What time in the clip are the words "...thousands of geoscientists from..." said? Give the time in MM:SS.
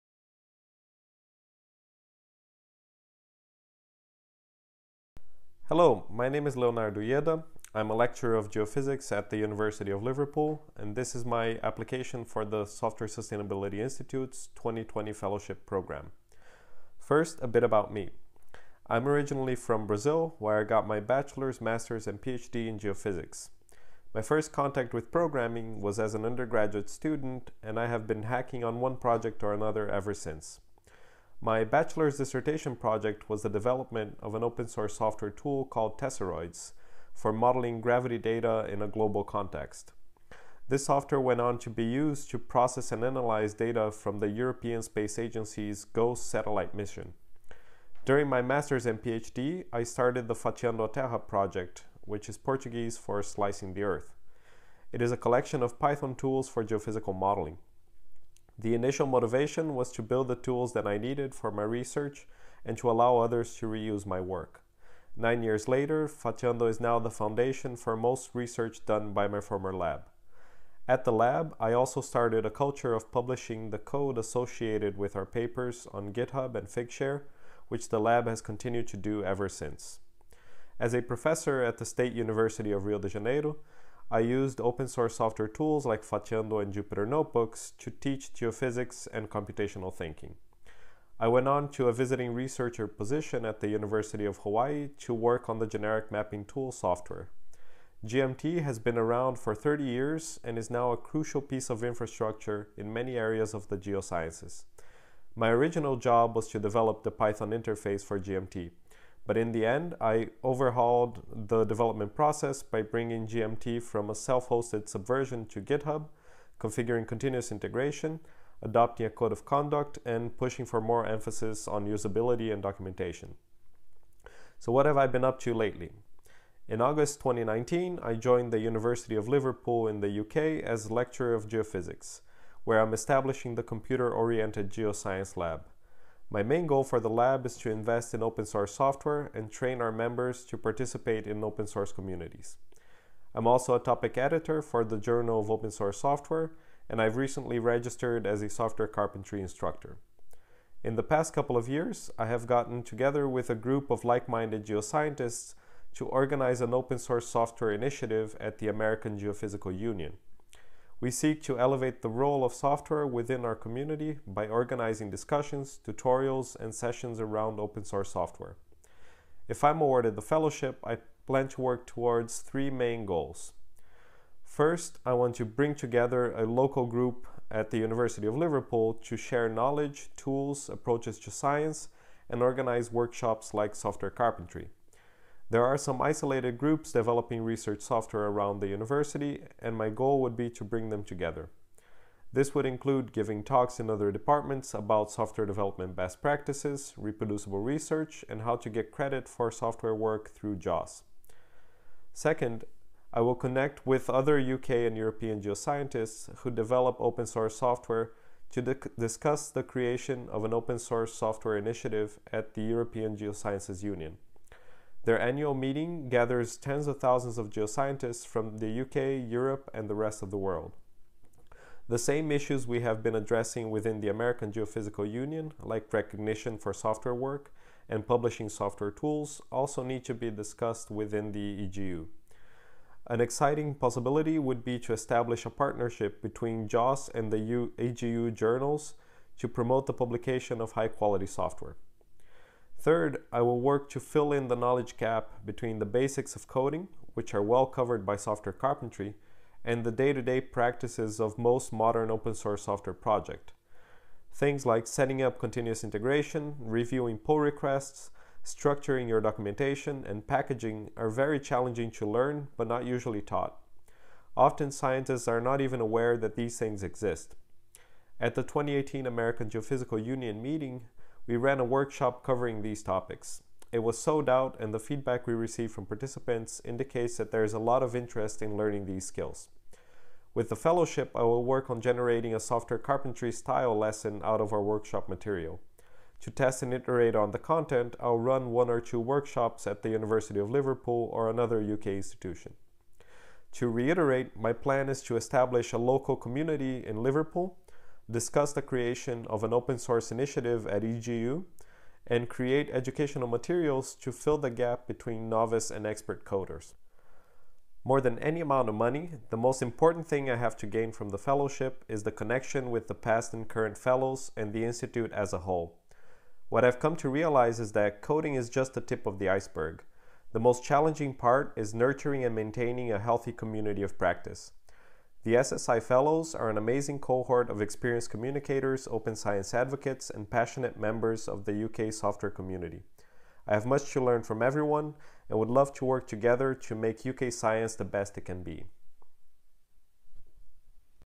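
03:36.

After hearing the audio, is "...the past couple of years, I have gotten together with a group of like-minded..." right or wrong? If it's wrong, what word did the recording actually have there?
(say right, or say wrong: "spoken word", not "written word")
right.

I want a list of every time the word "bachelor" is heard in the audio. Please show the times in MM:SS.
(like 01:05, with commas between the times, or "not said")
00:20, 00:31.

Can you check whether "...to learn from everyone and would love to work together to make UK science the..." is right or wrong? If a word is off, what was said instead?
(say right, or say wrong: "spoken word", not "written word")
right.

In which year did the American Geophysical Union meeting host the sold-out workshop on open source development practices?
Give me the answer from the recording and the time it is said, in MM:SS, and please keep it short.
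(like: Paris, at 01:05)
2018, at 04:28.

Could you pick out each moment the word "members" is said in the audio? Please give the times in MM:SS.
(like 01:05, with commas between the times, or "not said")
02:19, 05:30.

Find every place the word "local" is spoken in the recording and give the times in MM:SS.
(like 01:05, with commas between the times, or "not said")
02:56, 04:55.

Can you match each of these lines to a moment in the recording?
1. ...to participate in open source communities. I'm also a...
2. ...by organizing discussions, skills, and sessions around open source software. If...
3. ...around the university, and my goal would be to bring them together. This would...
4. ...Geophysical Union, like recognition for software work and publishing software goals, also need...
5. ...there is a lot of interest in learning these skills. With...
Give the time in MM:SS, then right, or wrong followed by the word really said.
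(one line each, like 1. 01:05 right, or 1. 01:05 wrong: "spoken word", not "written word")
1. 02:20 right
2. 02:44 wrong: "tutorials", not "skills"
3. 03:08 right
4. 03:44 wrong: "tools", not "goals"
5. 04:37 right.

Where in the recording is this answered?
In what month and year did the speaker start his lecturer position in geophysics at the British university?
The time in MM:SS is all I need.
02:06.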